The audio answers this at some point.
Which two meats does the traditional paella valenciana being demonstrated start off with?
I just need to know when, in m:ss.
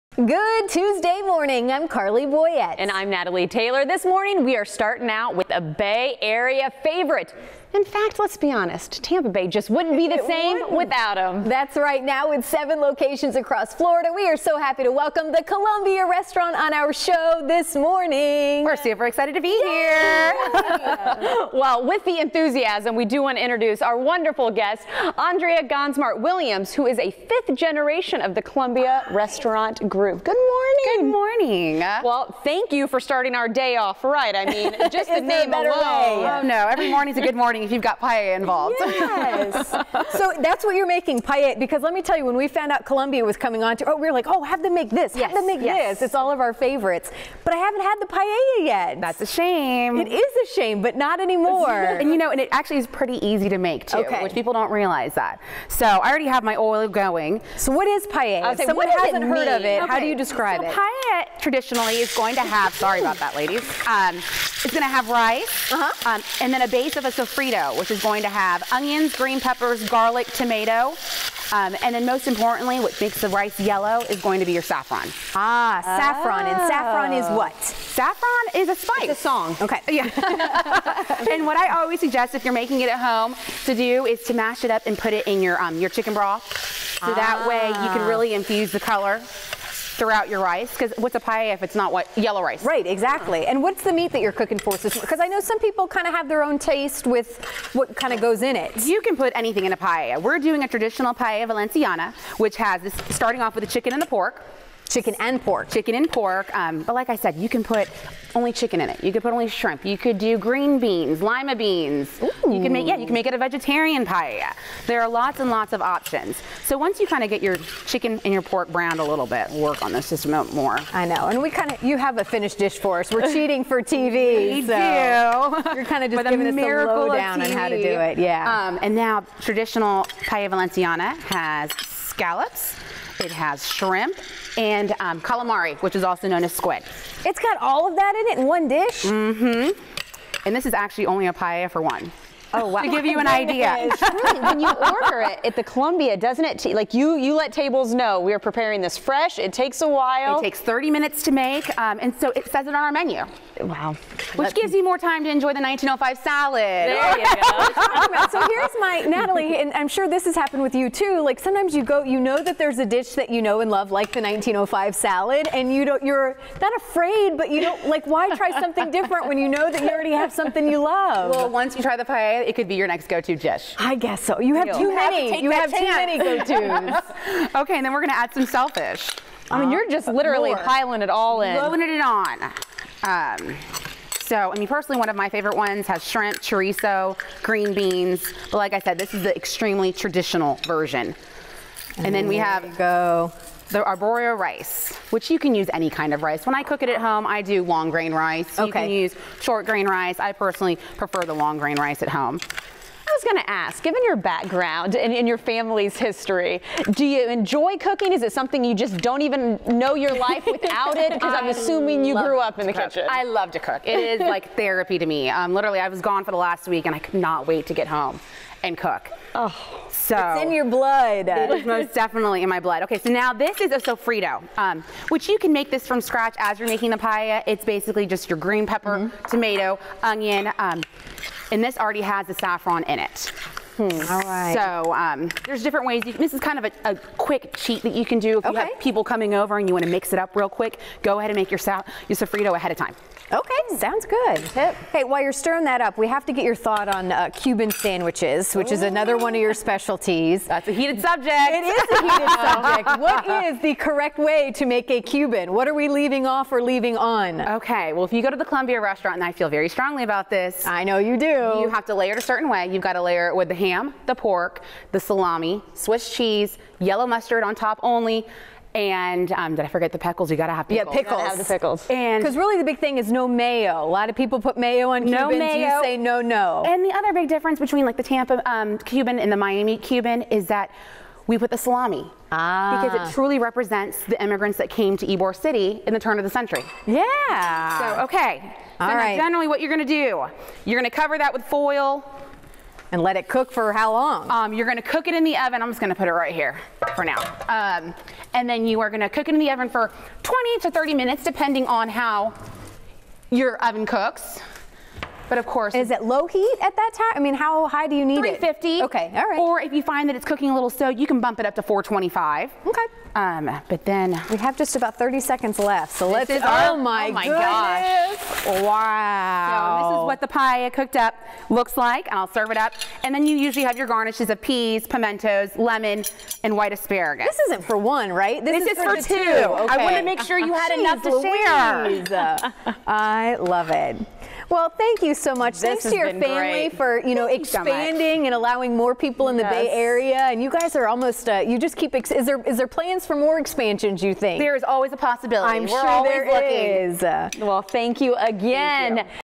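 1:43.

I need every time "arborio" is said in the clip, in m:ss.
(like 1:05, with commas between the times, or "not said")
3:13.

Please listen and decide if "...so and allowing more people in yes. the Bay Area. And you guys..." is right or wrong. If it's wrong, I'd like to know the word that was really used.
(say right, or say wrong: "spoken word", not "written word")
right.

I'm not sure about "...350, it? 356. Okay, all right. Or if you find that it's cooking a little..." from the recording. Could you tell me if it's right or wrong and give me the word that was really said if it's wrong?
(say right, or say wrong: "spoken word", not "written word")
wrong: "350", not "356".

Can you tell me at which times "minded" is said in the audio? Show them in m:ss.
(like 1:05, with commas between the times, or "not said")
not said.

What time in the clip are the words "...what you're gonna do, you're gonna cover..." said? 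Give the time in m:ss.
4:49.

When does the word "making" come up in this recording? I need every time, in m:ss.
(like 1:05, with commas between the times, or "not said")
0:40, 1:22, 3:46.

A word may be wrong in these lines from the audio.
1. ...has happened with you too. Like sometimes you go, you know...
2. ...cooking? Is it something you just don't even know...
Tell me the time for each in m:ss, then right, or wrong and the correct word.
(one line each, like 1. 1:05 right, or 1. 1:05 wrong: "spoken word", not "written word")
1. 2:40 right
2. 3:27 right.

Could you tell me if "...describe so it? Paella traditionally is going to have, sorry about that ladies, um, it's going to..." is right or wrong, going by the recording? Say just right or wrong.
right.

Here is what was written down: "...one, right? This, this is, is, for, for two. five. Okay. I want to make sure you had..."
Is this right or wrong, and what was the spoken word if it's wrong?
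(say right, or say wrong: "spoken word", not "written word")
wrong: "two", not "five".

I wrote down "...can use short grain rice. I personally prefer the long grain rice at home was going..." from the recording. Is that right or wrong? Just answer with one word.
right.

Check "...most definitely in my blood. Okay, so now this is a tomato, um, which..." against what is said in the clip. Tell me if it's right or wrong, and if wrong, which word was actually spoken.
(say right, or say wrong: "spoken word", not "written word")
wrong: "sofrito", not "tomato".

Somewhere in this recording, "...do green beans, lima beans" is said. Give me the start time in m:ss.
1:50.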